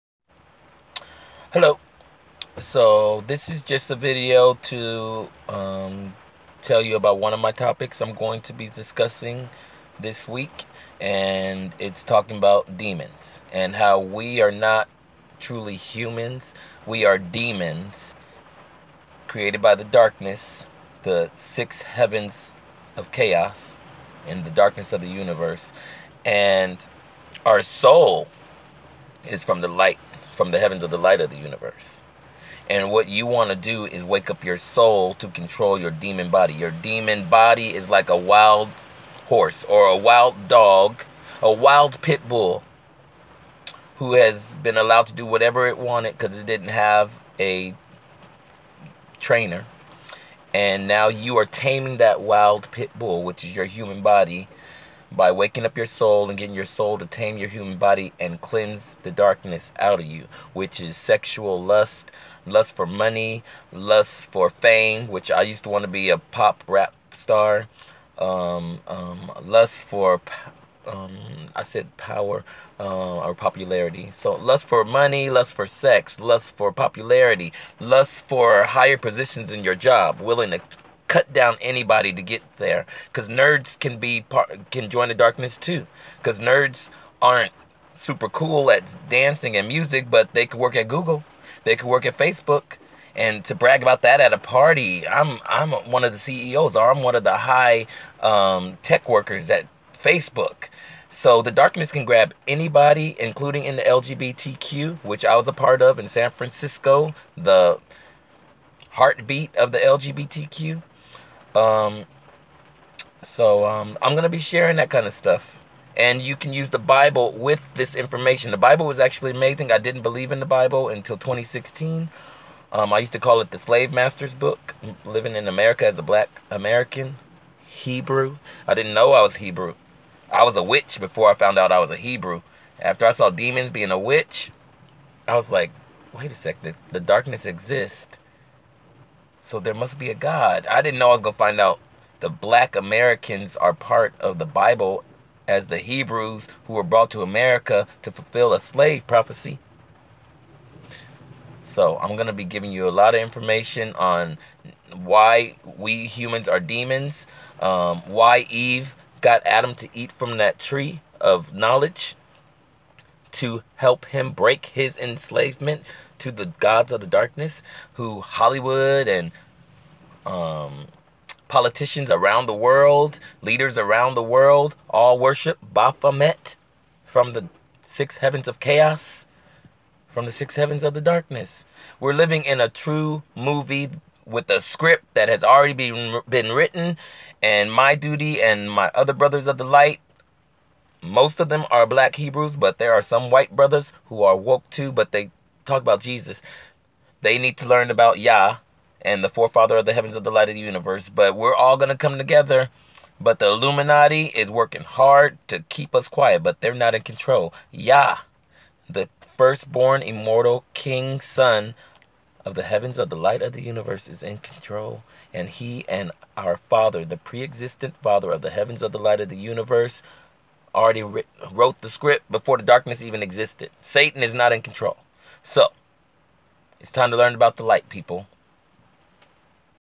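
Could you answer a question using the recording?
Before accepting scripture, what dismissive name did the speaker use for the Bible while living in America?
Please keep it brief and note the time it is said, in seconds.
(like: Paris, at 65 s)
Slave Master's Book, at 123 s.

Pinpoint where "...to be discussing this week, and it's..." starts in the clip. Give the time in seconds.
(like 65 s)
8 s.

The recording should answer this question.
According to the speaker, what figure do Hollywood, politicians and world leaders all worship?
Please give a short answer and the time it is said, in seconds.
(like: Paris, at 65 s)
Baphomet, at 175 s.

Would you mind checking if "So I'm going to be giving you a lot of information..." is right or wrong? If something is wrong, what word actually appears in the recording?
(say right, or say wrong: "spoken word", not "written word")
right.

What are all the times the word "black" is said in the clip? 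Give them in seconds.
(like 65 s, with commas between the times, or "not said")
126 s, 142 s, 191 s.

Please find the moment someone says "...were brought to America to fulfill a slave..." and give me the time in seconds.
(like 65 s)
146 s.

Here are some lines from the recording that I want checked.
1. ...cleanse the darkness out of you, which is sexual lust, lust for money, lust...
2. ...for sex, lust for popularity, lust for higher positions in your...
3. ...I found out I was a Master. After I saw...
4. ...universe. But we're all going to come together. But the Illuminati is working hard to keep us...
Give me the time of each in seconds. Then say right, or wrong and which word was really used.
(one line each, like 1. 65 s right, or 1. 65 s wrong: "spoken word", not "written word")
1. 58 s right
2. 75 s right
3. 131 s wrong: "Hebrew", not "Master"
4. 200 s right.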